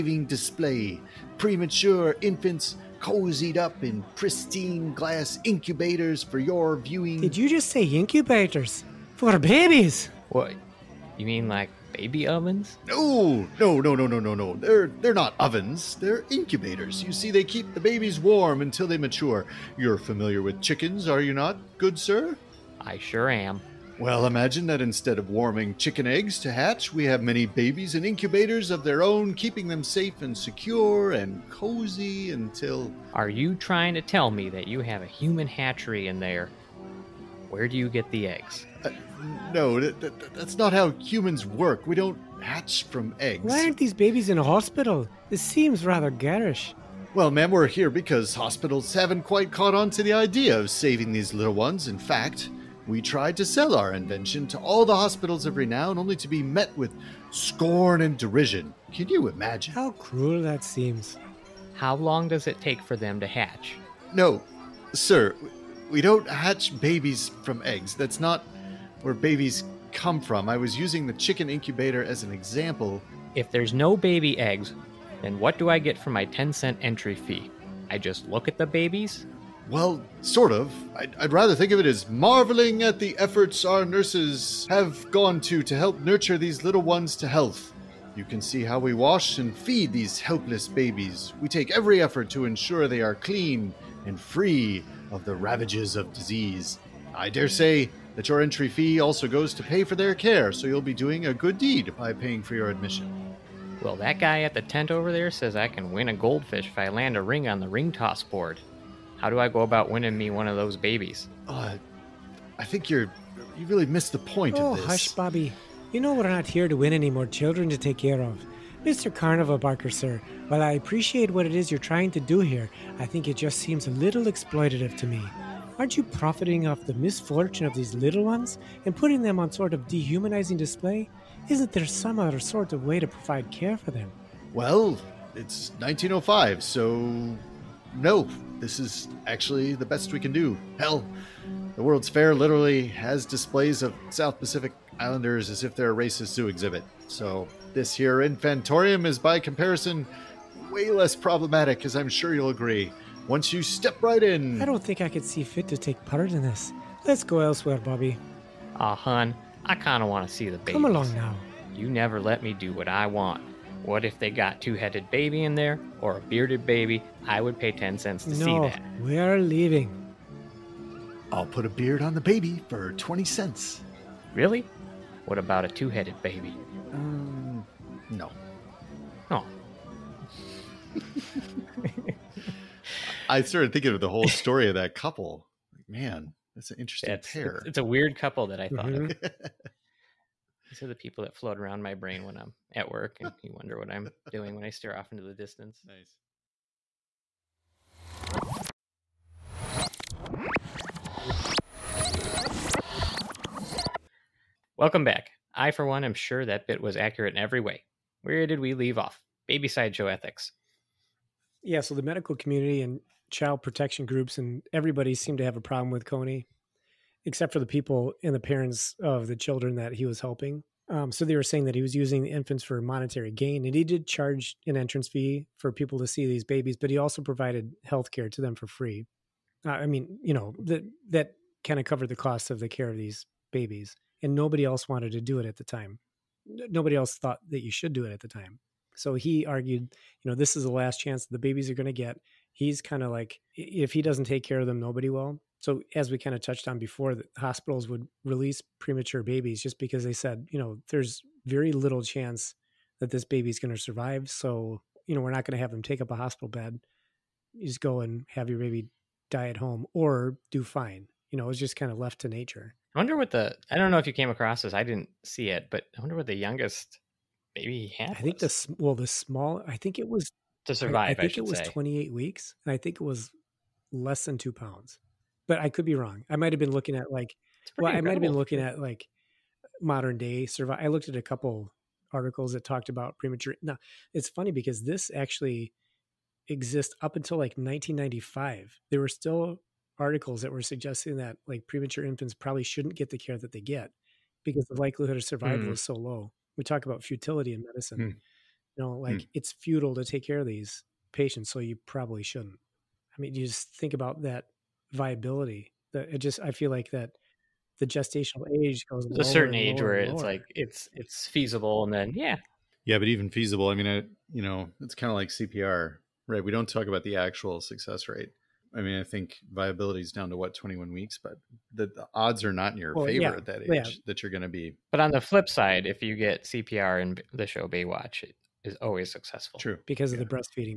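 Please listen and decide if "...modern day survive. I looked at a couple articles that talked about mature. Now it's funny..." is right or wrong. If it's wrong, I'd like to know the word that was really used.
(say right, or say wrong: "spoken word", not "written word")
wrong: "premature", not "mature".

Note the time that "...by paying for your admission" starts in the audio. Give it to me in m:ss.
1:41.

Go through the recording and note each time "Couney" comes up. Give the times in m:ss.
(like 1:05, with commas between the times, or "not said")
3:36.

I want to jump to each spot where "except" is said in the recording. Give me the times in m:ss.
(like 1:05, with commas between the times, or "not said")
3:37.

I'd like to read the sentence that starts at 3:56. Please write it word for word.
Nobody else thought that you should do it at the time.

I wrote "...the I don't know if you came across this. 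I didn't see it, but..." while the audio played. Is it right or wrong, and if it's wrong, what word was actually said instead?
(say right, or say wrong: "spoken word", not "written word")
right.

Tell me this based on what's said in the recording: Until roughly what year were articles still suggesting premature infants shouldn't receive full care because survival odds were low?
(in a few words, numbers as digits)
1995.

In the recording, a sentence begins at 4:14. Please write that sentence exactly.
So you know, we're not going to have them take up a hospital bed.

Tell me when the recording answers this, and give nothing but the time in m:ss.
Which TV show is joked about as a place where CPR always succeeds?
5:27.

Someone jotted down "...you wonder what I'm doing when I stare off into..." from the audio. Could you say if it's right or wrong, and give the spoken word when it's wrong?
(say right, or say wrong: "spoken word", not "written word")
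right.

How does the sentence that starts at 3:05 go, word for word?
Like, man, that's an interesting it's, pair.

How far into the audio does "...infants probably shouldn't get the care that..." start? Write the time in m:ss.
4:52.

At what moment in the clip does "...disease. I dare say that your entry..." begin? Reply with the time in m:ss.
1:36.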